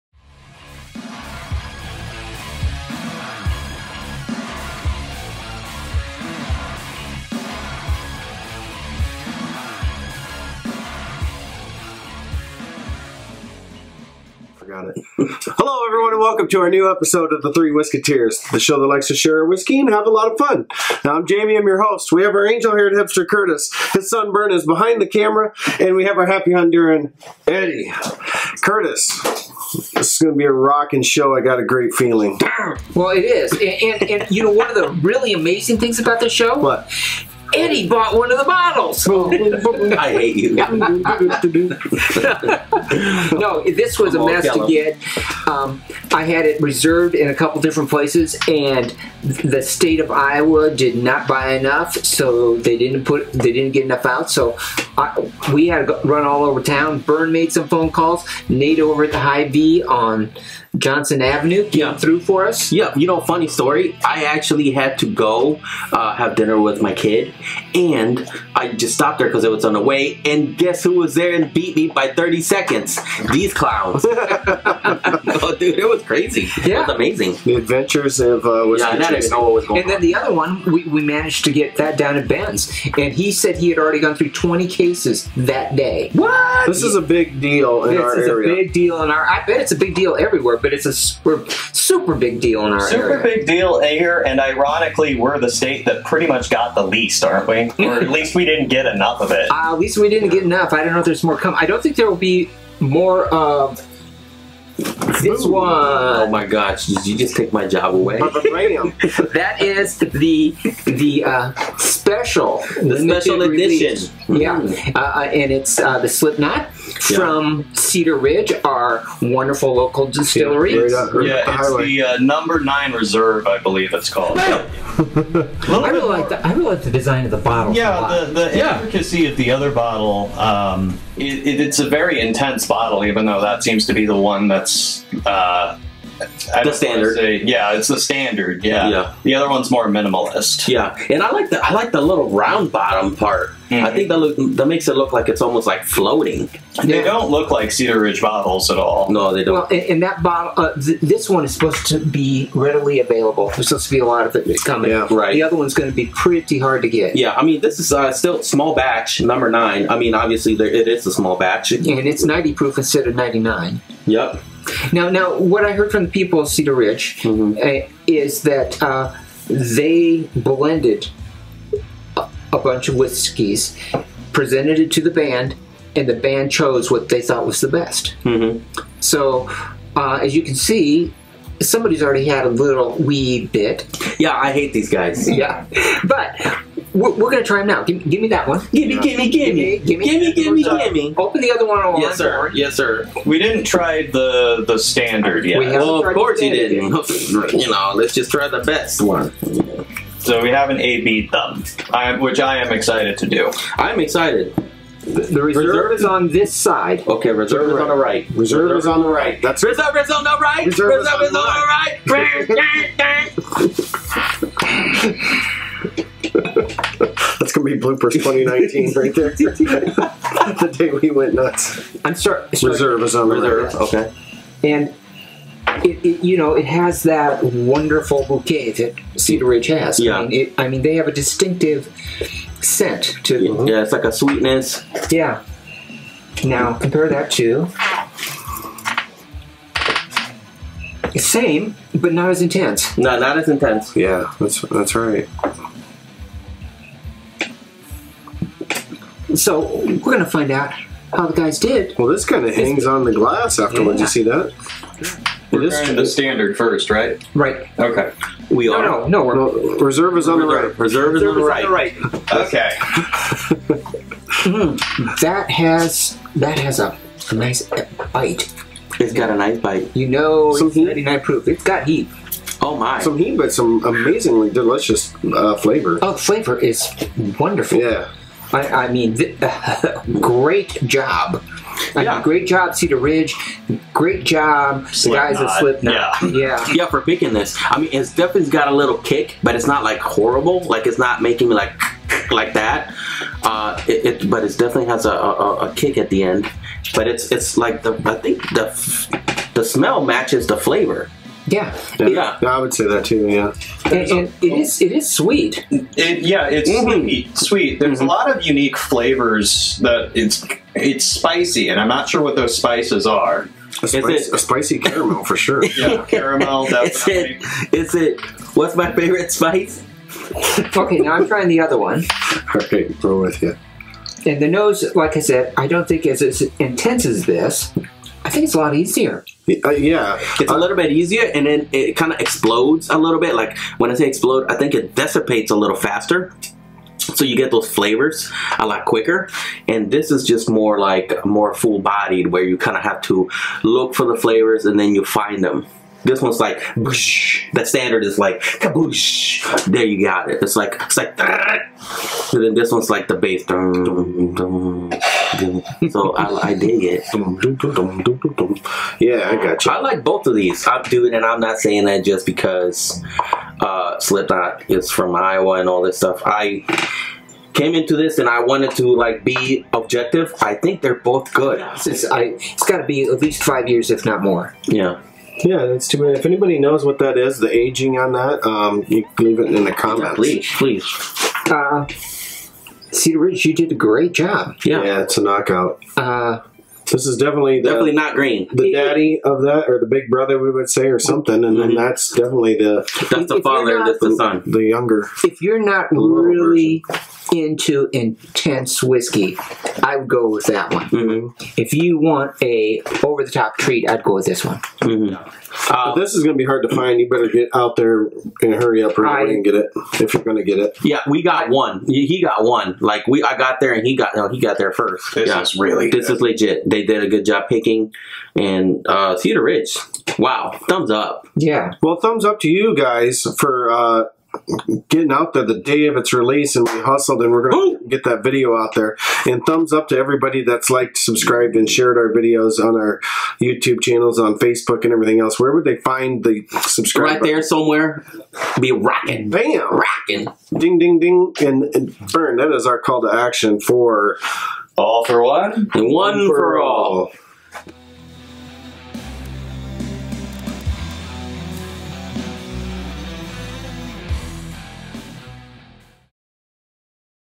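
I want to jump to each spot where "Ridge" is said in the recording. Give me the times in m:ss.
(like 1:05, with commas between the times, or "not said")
1:58, 2:27, 2:46, 3:49, 4:42, 6:23, 6:59.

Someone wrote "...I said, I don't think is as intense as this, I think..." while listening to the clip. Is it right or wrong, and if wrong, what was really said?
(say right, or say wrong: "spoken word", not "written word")
right.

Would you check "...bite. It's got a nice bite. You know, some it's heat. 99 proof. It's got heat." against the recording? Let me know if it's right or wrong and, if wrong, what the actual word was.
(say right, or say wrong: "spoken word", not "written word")
right.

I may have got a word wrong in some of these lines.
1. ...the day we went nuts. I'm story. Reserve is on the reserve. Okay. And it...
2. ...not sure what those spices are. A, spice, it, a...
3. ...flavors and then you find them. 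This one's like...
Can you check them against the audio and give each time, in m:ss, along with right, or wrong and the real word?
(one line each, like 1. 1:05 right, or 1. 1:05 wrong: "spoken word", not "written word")
1. 3:39 wrong: "sorry", not "story"
2. 5:11 right
3. 5:44 right.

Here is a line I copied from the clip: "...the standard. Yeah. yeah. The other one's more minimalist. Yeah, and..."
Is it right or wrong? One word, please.
right.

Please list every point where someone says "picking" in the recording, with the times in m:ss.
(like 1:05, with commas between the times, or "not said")
4:47, 6:57.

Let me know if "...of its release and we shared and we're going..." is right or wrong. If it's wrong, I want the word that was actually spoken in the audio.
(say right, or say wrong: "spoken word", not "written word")
wrong: "hustled", not "shared".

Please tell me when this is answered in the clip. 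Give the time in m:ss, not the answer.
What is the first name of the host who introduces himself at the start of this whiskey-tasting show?
0:21.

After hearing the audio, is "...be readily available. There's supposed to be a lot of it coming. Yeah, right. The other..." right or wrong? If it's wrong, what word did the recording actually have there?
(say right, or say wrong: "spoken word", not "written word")
right.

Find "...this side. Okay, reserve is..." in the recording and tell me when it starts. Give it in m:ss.
3:26.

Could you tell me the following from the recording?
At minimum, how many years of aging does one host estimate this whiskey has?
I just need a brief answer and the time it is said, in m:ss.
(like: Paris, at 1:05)
5 years, at 6:13.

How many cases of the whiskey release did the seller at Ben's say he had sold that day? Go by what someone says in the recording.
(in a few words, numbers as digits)
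20.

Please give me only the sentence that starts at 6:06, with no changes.
I came into this and I wanted to like be objective.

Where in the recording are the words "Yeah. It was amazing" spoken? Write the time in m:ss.
1:16.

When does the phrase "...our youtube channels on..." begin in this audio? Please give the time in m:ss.
7:12.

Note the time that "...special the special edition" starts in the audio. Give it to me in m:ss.
1:51.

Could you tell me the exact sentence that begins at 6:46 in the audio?
You better get out there and hurry up right away and get it if you're going to get it.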